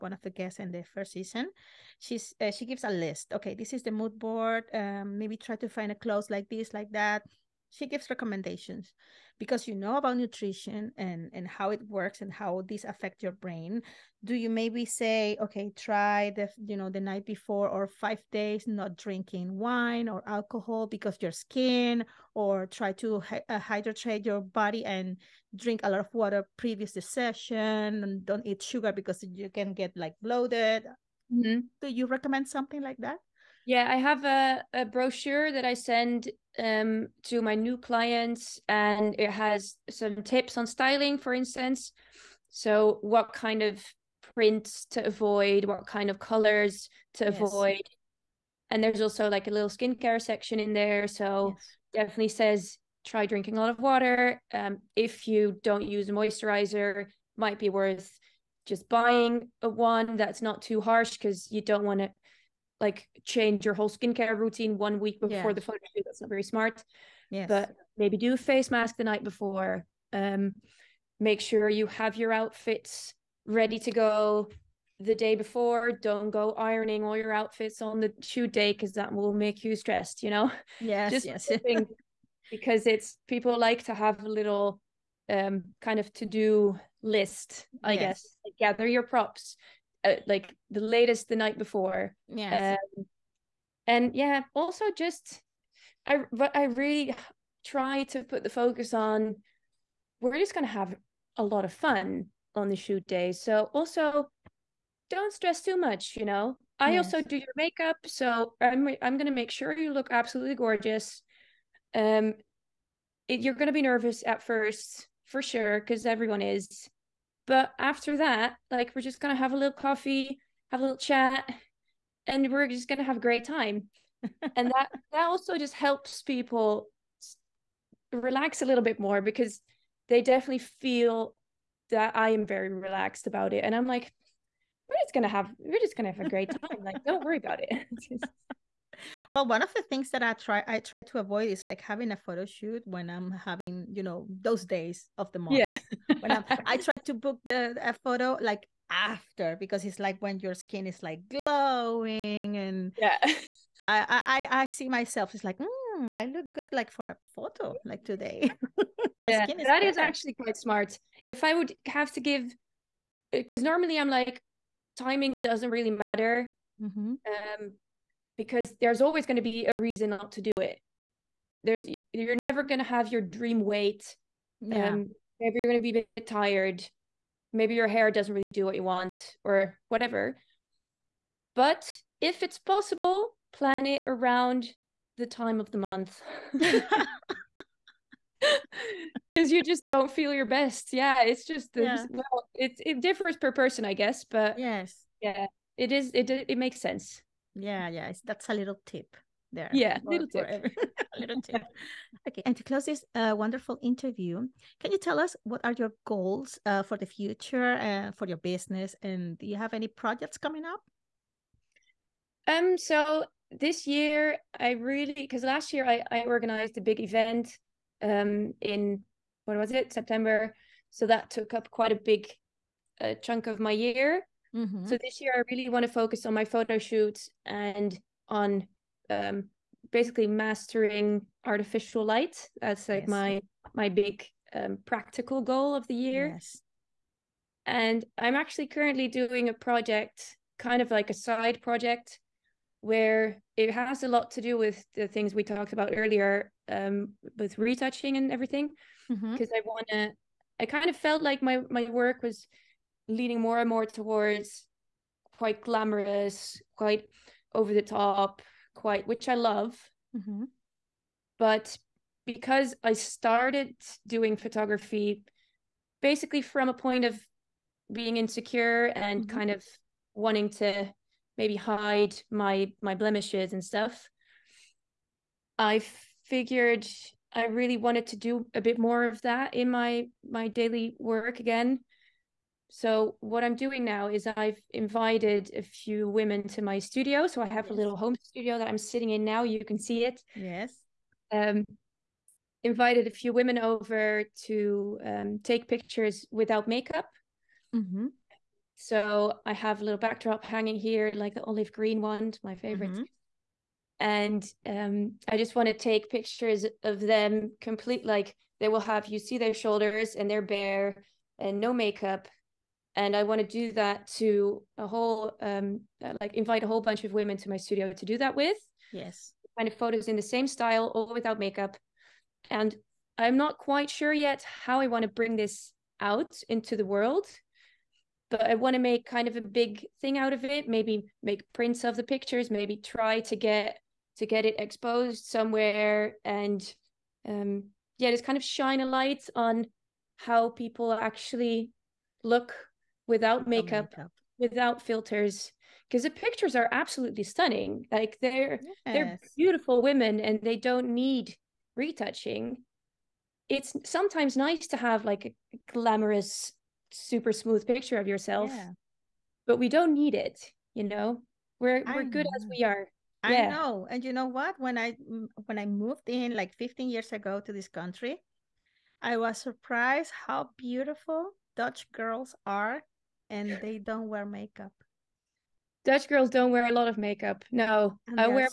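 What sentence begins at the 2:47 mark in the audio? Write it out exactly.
um because there's always going to be a reason not to do it.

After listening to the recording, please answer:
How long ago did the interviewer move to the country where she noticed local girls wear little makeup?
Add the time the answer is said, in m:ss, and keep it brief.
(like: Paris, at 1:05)
15 years, at 6:06.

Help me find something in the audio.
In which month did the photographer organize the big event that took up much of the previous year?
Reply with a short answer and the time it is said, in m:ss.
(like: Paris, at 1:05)
September, at 3:39.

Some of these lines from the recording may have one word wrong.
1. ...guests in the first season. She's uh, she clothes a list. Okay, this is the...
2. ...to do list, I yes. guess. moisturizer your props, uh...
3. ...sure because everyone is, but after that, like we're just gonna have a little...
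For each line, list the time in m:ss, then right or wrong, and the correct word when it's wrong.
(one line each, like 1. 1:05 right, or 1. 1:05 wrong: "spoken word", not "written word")
1. 0:00 wrong: "gives", not "clothes"
2. 1:26 wrong: "gather", not "moisturizer"
3. 1:55 right.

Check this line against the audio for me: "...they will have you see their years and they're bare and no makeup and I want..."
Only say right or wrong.
wrong.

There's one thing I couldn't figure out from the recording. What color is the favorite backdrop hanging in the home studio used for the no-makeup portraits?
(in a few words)
Olive green.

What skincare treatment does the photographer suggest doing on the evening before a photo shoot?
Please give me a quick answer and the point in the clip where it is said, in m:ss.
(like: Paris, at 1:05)
A face mask, at 1:08.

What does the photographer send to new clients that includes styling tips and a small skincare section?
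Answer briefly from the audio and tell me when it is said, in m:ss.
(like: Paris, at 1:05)
A brochure, at 0:34.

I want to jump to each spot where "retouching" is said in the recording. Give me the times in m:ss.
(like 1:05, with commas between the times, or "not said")
4:07, 5:51.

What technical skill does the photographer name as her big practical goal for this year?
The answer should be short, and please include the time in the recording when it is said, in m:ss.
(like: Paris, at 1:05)
Mastering artificial light, at 3:50.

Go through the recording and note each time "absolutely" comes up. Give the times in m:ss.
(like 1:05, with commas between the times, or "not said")
1:50, 5:46.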